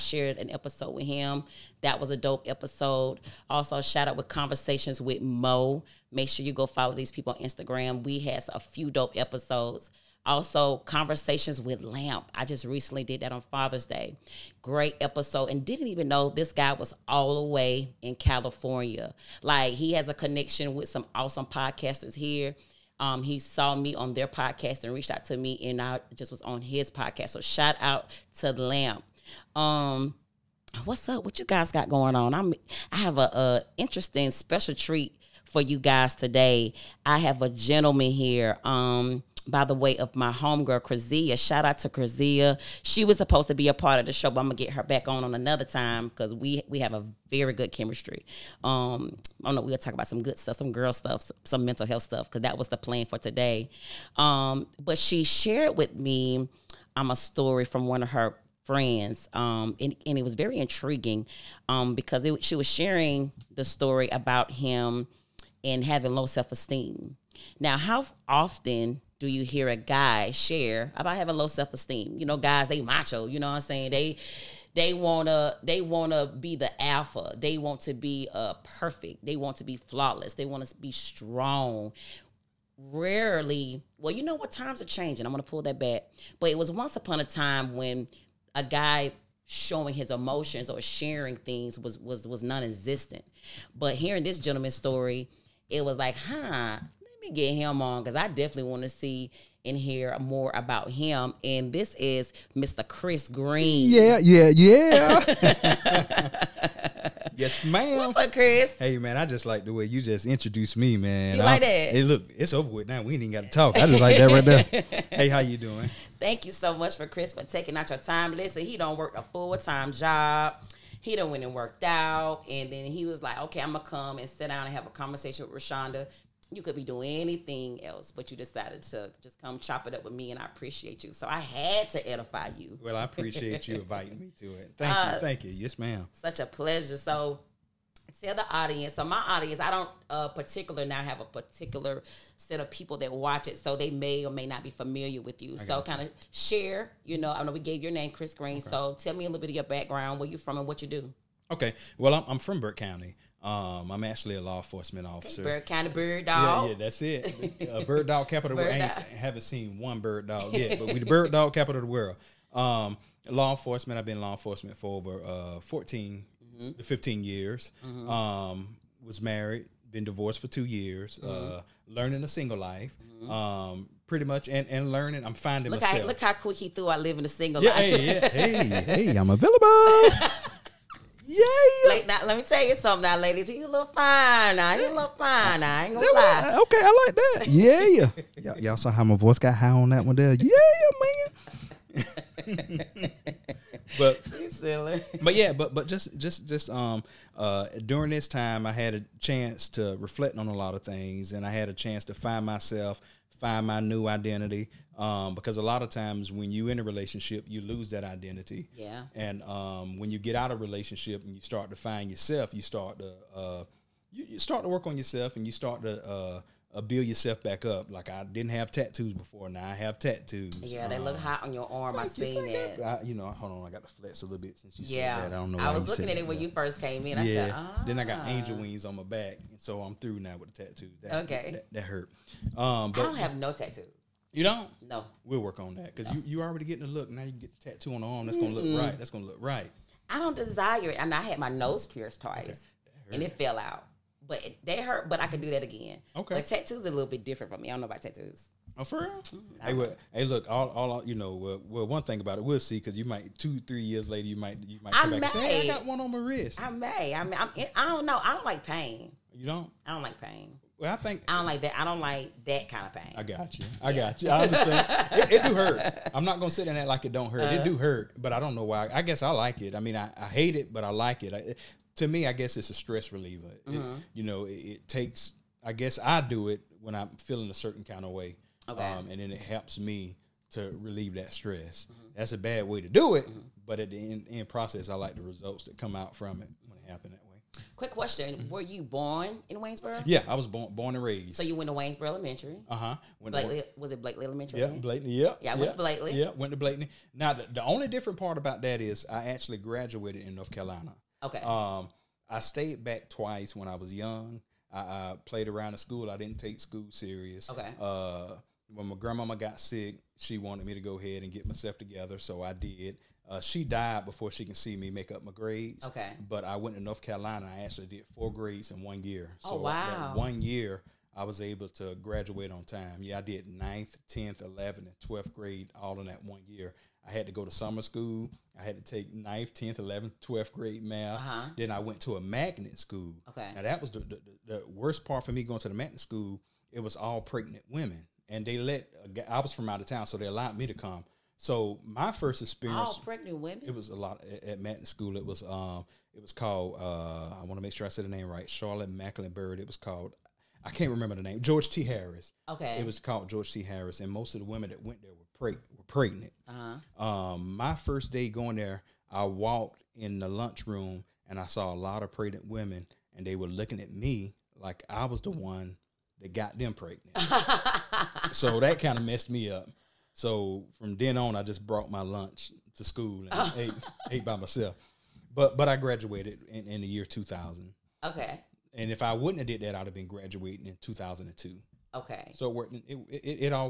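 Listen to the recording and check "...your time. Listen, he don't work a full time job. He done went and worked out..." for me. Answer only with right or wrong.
right.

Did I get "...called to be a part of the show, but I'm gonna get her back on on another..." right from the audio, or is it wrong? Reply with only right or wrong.
wrong.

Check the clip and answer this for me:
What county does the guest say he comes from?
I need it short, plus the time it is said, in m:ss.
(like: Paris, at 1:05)
Burke County, at 2:32.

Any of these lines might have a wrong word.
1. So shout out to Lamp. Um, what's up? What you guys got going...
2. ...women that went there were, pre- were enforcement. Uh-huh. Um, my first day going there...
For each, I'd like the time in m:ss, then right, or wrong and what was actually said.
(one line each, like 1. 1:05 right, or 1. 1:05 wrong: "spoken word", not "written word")
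1. 0:27 right
2. 5:54 wrong: "pregnant", not "enforcement".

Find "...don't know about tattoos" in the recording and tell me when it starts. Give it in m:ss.
4:07.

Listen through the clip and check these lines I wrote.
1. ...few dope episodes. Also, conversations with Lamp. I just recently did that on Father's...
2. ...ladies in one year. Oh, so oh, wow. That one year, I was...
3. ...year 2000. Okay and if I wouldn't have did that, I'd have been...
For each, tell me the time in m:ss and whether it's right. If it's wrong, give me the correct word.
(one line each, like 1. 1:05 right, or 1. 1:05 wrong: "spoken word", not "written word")
1. 0:08 right
2. 5:18 wrong: "grades", not "ladies"
3. 6:16 right.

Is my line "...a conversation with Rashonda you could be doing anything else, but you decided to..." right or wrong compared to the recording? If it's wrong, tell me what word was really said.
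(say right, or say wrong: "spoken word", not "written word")
right.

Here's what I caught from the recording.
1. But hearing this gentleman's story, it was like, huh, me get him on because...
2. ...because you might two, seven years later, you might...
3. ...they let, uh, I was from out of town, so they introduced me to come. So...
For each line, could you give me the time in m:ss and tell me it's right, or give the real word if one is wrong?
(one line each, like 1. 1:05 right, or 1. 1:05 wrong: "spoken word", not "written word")
1. 1:33 right
2. 4:12 wrong: "three", not "seven"
3. 5:38 wrong: "allowed", not "introduced".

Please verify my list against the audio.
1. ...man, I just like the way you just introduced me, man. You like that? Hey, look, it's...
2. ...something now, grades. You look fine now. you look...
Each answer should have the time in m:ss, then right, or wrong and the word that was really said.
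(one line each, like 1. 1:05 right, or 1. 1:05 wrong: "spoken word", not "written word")
1. 1:48 right
2. 3:02 wrong: "ladies", not "grades".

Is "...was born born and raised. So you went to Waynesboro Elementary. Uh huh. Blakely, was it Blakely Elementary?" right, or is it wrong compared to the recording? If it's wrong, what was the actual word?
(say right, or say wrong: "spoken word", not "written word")
right.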